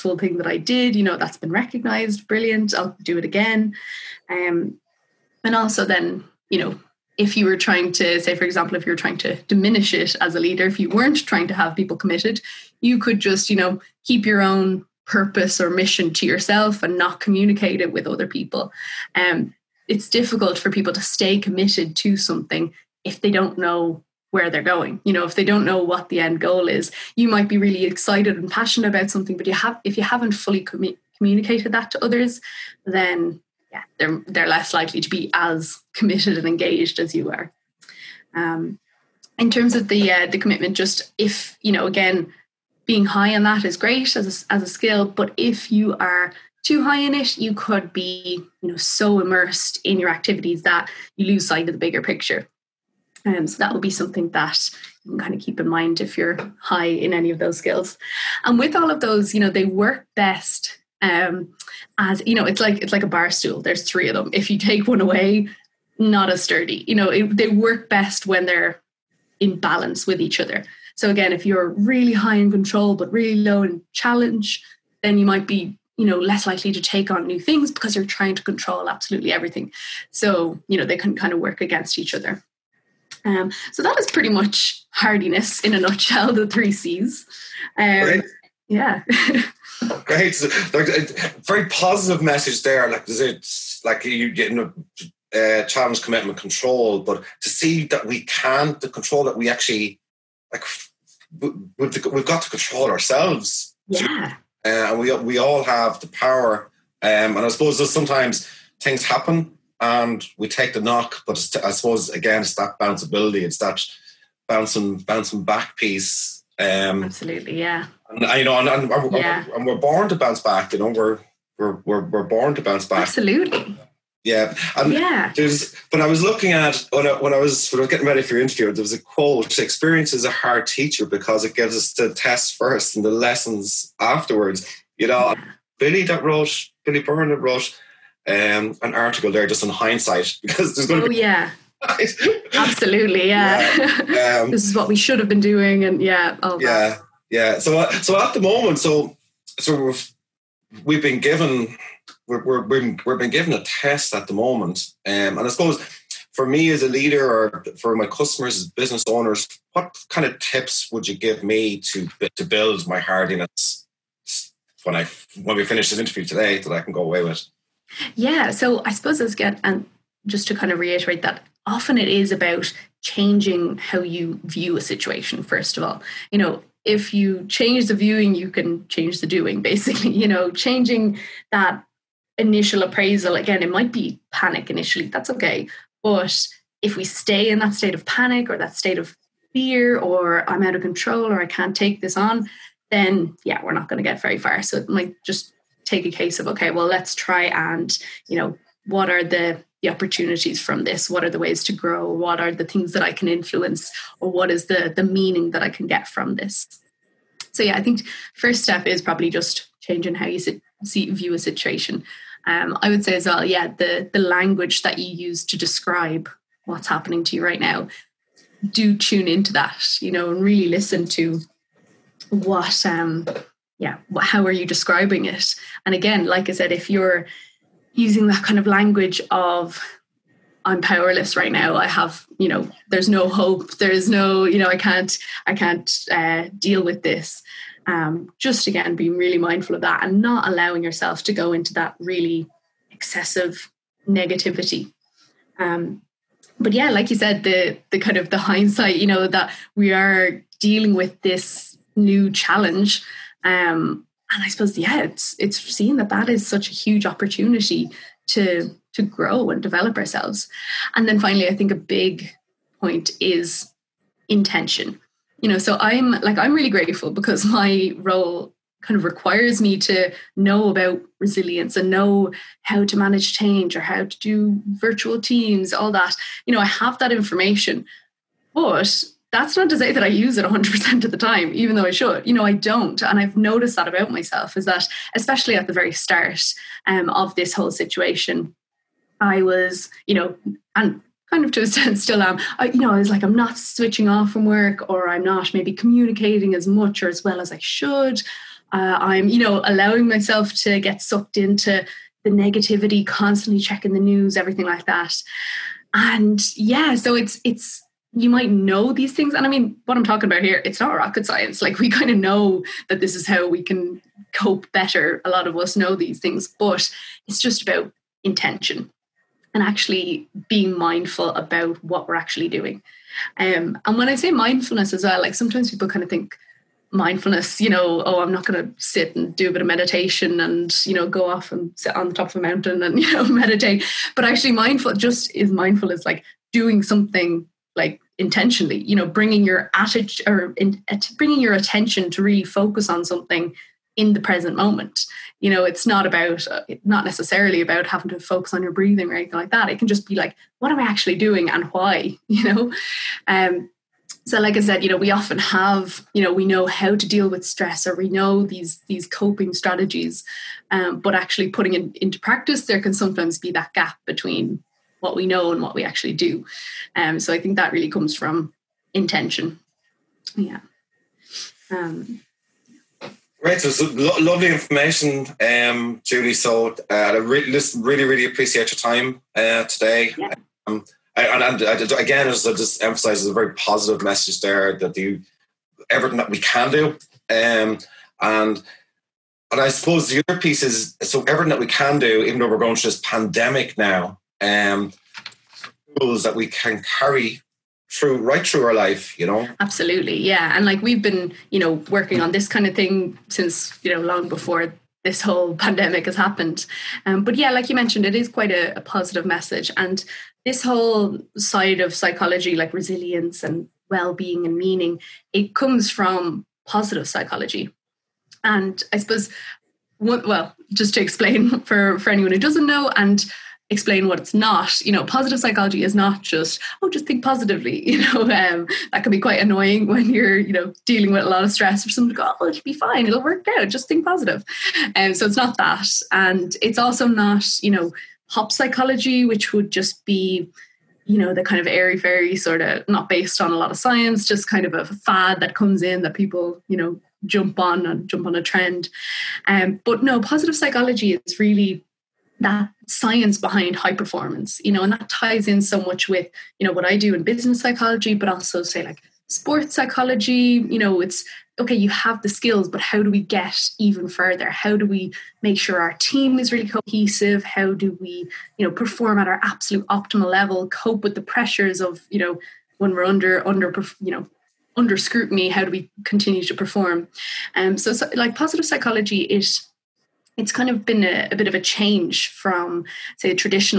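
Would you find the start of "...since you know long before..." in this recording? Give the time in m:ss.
6:43.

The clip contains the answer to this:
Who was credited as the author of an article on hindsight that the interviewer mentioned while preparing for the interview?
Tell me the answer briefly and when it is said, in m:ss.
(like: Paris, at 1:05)
Billy Byrne, at 2:16.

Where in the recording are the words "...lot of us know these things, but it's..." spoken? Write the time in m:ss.
5:15.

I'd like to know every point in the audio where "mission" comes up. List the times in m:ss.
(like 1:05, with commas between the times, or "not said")
0:15.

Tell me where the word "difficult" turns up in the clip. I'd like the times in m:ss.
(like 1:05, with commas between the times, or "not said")
0:20.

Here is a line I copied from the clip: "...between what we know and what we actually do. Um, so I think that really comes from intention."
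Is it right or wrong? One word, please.
right.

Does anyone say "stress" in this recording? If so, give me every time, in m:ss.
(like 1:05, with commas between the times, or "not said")
5:57, 7:11.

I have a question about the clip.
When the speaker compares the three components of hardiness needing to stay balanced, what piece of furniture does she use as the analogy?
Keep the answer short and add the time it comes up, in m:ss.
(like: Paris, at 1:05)
bar stool, at 1:03.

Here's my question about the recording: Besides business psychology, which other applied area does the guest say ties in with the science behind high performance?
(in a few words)
sports psychology.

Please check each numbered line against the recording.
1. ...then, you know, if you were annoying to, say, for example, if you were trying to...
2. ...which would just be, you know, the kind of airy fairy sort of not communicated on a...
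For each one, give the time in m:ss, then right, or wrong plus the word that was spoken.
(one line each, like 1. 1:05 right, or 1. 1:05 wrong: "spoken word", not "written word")
1. 0:05 wrong: "trying", not "annoying"
2. 7:19 wrong: "based", not "communicated".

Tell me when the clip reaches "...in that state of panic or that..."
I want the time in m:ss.
3:07.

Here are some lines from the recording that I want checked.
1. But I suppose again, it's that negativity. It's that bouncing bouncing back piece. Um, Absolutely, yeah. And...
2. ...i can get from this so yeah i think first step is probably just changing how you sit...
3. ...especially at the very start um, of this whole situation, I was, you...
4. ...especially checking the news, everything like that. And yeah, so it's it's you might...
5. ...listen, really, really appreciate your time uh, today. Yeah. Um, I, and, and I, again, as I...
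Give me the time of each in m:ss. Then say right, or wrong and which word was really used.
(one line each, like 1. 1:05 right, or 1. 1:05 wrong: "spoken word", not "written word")
1. 1:51 wrong: "bounceability", not "negativity"
2. 3:25 right
3. 4:45 right
4. 5:03 wrong: "constantly", not "especially"
5. 6:17 right.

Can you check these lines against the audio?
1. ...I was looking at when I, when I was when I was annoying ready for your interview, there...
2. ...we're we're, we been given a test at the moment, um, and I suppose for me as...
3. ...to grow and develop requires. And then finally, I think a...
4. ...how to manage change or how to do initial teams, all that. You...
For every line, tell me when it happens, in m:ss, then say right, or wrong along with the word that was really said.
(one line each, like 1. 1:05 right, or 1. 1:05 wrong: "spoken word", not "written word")
1. 2:06 wrong: "getting", not "annoying"
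2. 2:32 right
3. 4:18 wrong: "ourselves", not "requires"
4. 4:32 wrong: "virtual", not "initial".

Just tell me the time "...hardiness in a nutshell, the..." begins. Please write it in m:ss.
1:24.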